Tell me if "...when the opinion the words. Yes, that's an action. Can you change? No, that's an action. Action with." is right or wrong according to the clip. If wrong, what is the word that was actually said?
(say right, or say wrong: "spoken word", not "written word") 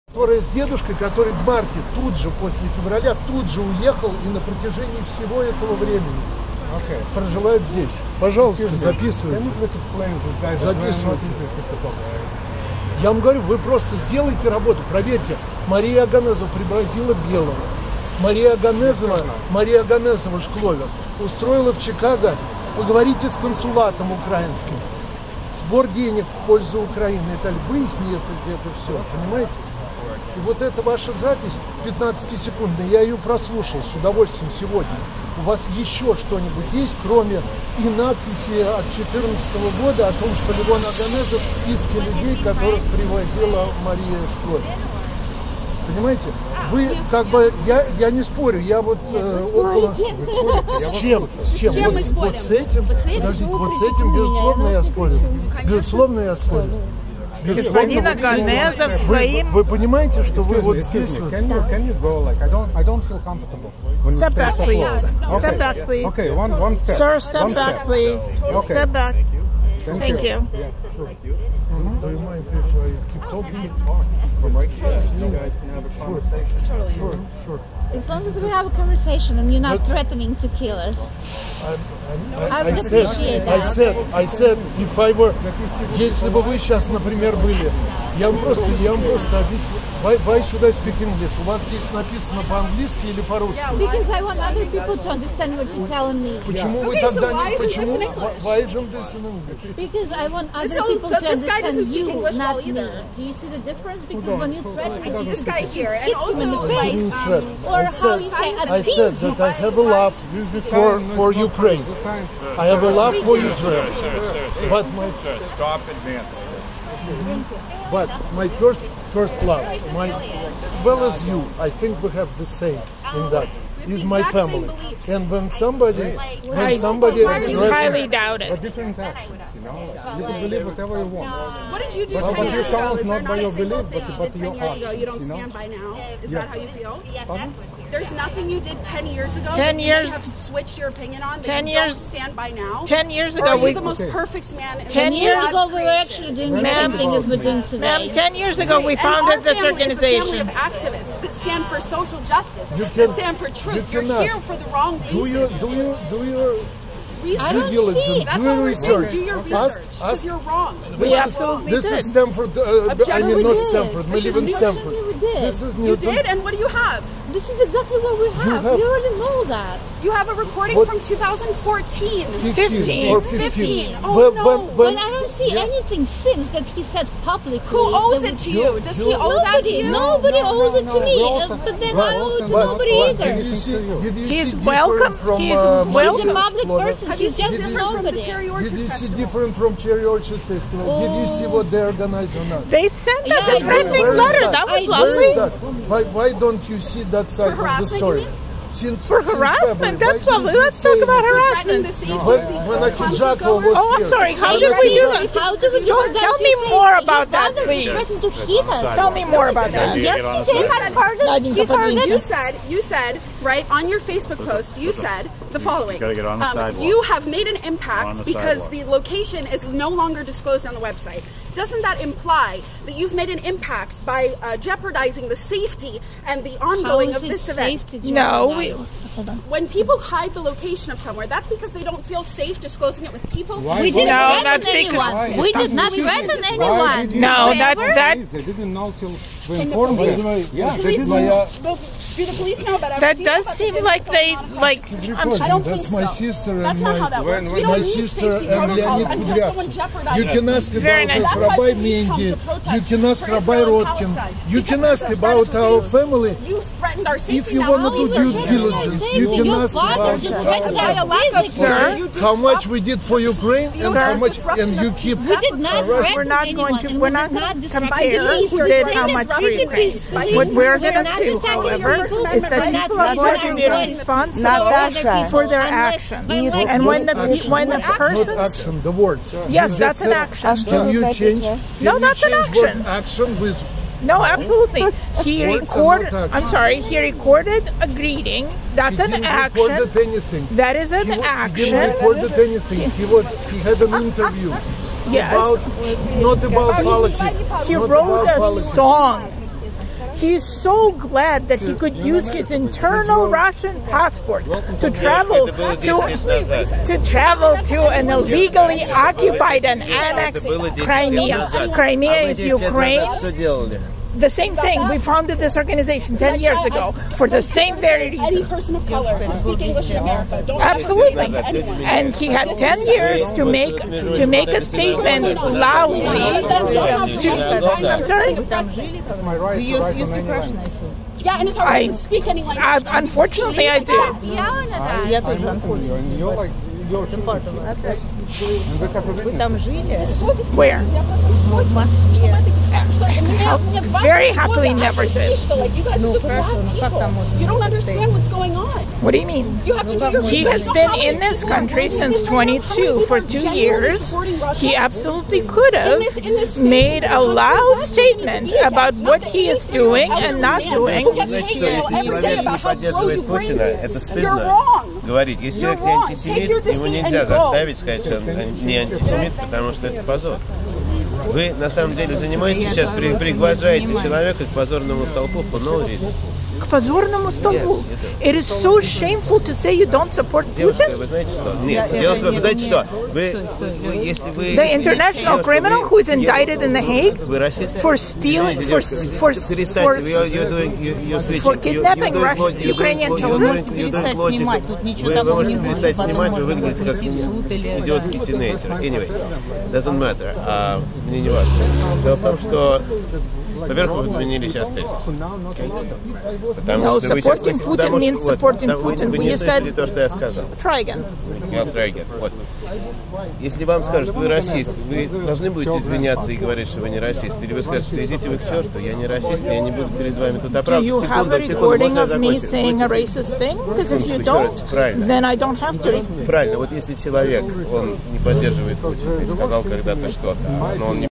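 wrong: "person", not "opinion".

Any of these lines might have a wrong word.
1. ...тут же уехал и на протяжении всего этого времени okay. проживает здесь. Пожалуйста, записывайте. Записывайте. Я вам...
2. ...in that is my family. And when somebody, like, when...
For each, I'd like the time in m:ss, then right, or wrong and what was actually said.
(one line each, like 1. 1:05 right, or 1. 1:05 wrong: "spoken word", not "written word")
1. 0:03 right
2. 2:03 right.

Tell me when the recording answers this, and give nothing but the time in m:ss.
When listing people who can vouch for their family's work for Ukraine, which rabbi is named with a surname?
4:13.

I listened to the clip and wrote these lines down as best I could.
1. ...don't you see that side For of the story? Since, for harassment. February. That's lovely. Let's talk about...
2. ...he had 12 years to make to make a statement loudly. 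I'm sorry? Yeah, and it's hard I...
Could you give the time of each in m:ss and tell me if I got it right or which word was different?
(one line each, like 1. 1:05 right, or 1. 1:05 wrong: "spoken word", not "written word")
1. 3:16 right
2. 5:22 wrong: "10", not "12".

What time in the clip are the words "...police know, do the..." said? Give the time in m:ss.
3:59.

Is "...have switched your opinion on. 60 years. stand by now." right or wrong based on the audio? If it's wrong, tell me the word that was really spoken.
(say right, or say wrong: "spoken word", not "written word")
wrong: "10", not "60".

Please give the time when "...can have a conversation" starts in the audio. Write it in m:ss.
1:15.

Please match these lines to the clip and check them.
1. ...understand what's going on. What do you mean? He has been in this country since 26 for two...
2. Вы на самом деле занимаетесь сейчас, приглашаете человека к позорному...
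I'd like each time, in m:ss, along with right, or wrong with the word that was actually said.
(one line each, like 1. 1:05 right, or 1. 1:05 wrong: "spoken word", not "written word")
1. 5:47 wrong: "22", not "26"
2. 6:11 right.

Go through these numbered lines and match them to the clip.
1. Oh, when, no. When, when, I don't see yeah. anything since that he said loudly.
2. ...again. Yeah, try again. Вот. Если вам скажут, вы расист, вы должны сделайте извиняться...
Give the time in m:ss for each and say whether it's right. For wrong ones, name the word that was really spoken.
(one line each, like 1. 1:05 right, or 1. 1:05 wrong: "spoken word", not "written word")
1. 2:54 wrong: "publicly", not "loudly"
2. 6:50 wrong: "будете", not "сделайте".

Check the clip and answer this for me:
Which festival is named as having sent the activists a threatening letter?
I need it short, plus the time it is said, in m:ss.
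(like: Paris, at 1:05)
Cherry Orchard Festival, at 3:09.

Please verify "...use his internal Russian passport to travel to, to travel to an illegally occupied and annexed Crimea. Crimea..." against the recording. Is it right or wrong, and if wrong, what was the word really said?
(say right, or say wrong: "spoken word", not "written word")
right.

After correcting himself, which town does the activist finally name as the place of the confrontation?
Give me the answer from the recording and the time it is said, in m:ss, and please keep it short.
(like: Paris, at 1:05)
Newton, at 2:45.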